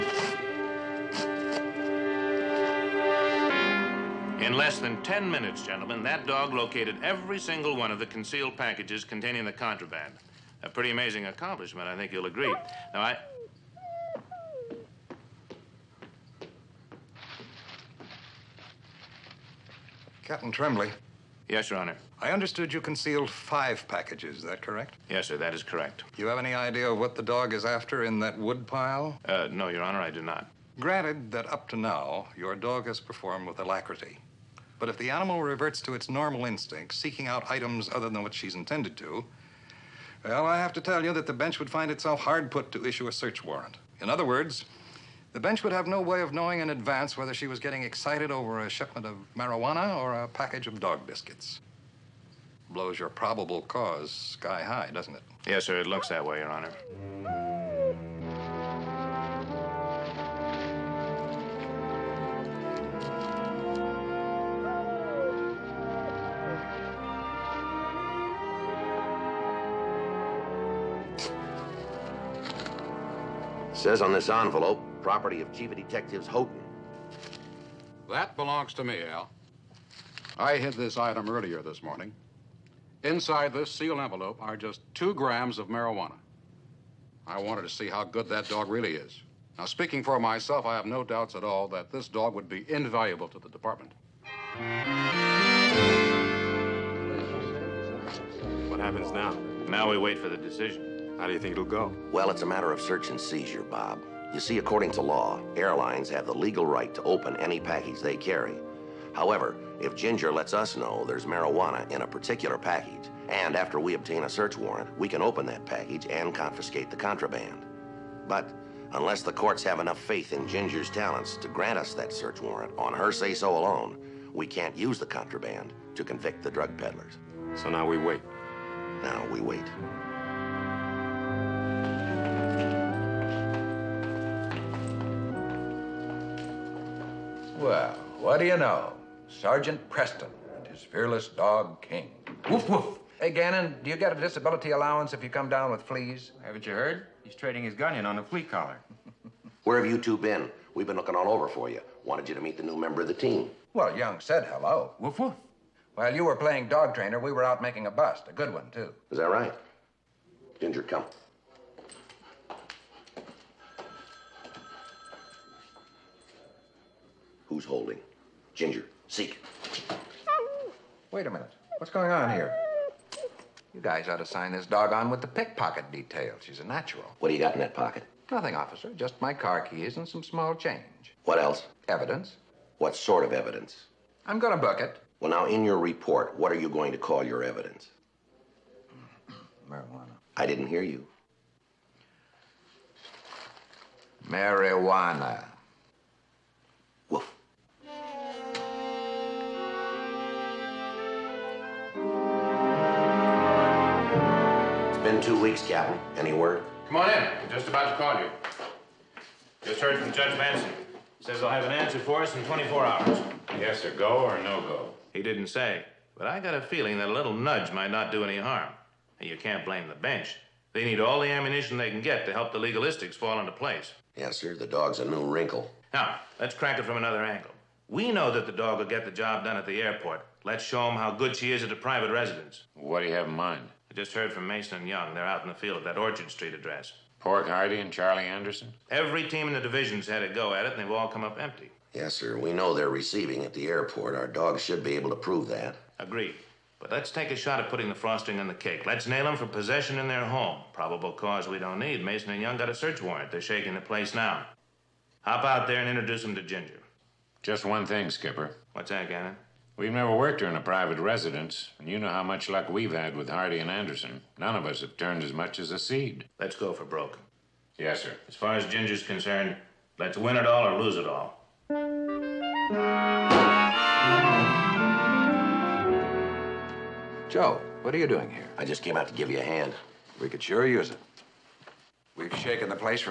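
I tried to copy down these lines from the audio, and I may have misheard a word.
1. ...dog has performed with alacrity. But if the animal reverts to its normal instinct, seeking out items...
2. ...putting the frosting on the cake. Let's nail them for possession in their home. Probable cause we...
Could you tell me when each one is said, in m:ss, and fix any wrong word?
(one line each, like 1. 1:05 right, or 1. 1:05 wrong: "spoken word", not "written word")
1. 0:32 right
2. 4:07 right.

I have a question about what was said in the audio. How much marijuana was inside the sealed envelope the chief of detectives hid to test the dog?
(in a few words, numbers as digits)
2 grams.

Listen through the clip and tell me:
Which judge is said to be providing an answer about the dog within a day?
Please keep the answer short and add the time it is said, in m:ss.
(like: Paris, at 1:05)
Judge Manson, at 3:30.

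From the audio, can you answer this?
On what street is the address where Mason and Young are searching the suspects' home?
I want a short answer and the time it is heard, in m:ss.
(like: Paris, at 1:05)
Orchard Street, at 3:55.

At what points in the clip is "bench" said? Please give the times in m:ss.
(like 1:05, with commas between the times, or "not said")
0:41, 0:45, 3:39.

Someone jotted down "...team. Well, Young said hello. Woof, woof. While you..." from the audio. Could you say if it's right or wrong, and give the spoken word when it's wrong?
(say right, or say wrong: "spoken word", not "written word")
right.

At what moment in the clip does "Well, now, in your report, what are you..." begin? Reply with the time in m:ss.
3:05.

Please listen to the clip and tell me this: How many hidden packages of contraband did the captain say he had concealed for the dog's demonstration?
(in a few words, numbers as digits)
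5.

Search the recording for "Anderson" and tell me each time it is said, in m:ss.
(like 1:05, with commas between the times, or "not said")
3:58, 4:23.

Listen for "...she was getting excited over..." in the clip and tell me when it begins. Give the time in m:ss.
0:47.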